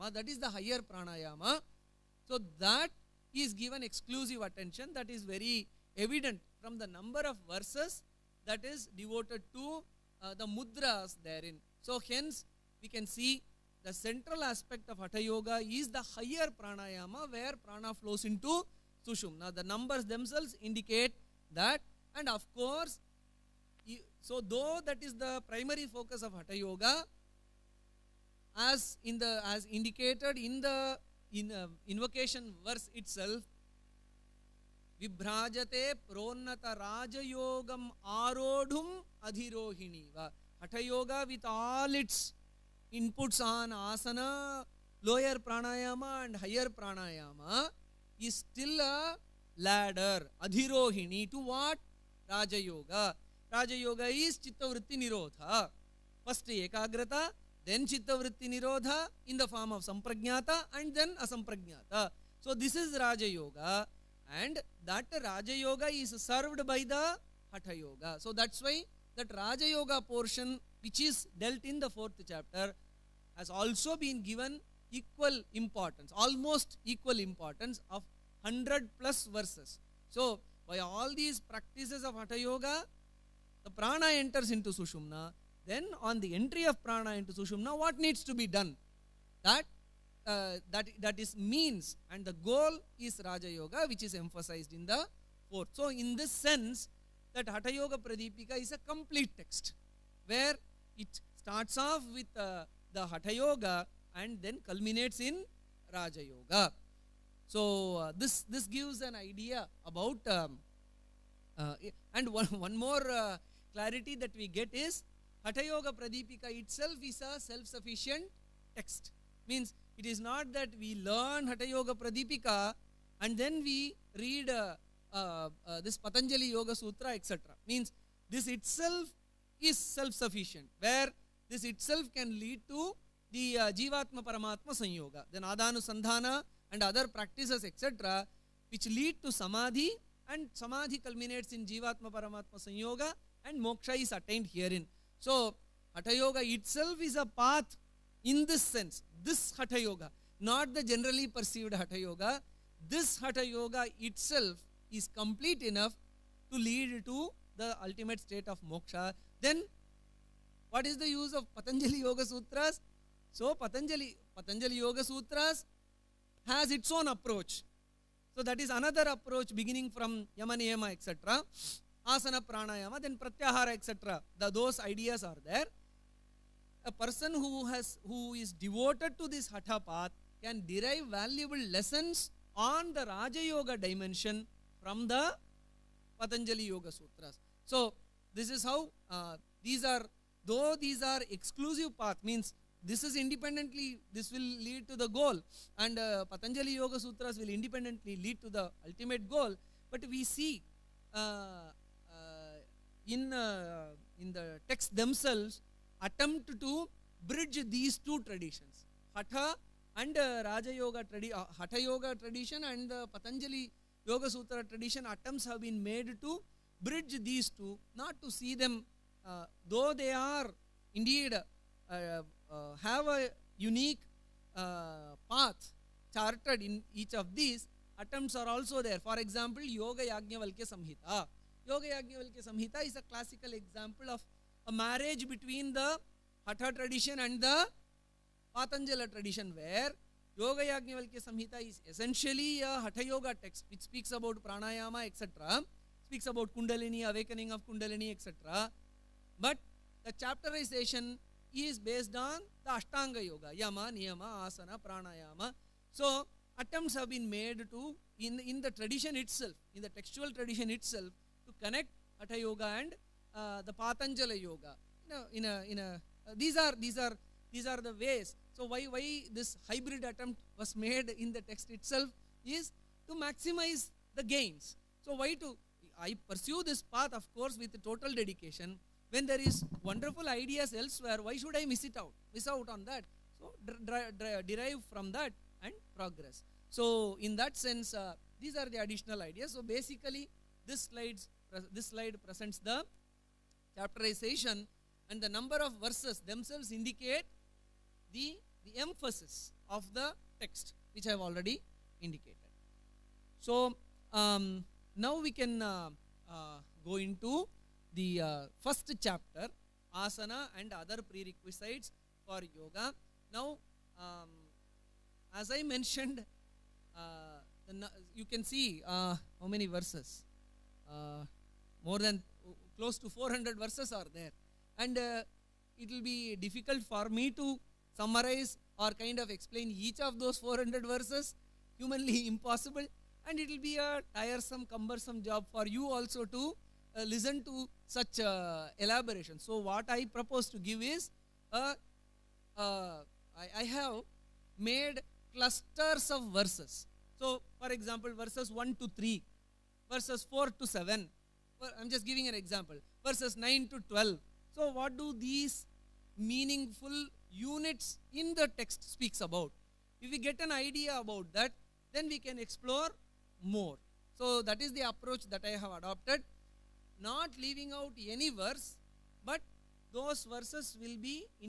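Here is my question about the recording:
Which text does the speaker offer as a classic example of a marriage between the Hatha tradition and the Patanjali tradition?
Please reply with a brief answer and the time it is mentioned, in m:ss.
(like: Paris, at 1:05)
Yoga Yajnavalkya Samhita, at 3:49.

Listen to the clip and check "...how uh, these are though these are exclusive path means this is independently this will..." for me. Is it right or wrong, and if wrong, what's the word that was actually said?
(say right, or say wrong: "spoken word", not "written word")
right.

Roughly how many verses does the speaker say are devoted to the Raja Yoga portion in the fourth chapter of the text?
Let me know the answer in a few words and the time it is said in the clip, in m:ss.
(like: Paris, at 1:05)
100 plus, at 1:18.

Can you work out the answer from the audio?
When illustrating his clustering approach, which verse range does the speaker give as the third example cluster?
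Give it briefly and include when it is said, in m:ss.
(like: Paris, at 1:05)
9 to 12, at 5:53.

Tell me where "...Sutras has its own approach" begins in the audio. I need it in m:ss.
2:45.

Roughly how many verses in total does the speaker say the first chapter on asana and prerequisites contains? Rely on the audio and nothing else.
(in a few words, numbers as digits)
close to 400.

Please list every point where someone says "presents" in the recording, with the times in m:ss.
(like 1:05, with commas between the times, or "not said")
4:52.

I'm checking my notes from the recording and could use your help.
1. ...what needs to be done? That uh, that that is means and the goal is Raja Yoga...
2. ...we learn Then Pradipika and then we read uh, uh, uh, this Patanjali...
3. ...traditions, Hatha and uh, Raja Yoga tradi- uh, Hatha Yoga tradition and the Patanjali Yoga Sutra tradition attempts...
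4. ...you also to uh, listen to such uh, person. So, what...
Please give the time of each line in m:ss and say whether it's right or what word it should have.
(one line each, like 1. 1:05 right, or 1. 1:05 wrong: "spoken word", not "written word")
1. 1:27 right
2. 2:00 wrong: "Hatha", not "Then"
3. 3:28 right
4. 5:35 wrong: "elaboration", not "person".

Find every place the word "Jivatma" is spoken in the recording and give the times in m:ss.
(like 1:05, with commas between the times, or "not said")
2:13, 2:21.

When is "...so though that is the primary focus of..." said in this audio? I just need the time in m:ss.
0:24.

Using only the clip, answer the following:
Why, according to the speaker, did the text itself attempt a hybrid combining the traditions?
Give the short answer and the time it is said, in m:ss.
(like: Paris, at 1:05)
to maximize the gains, at 4:33.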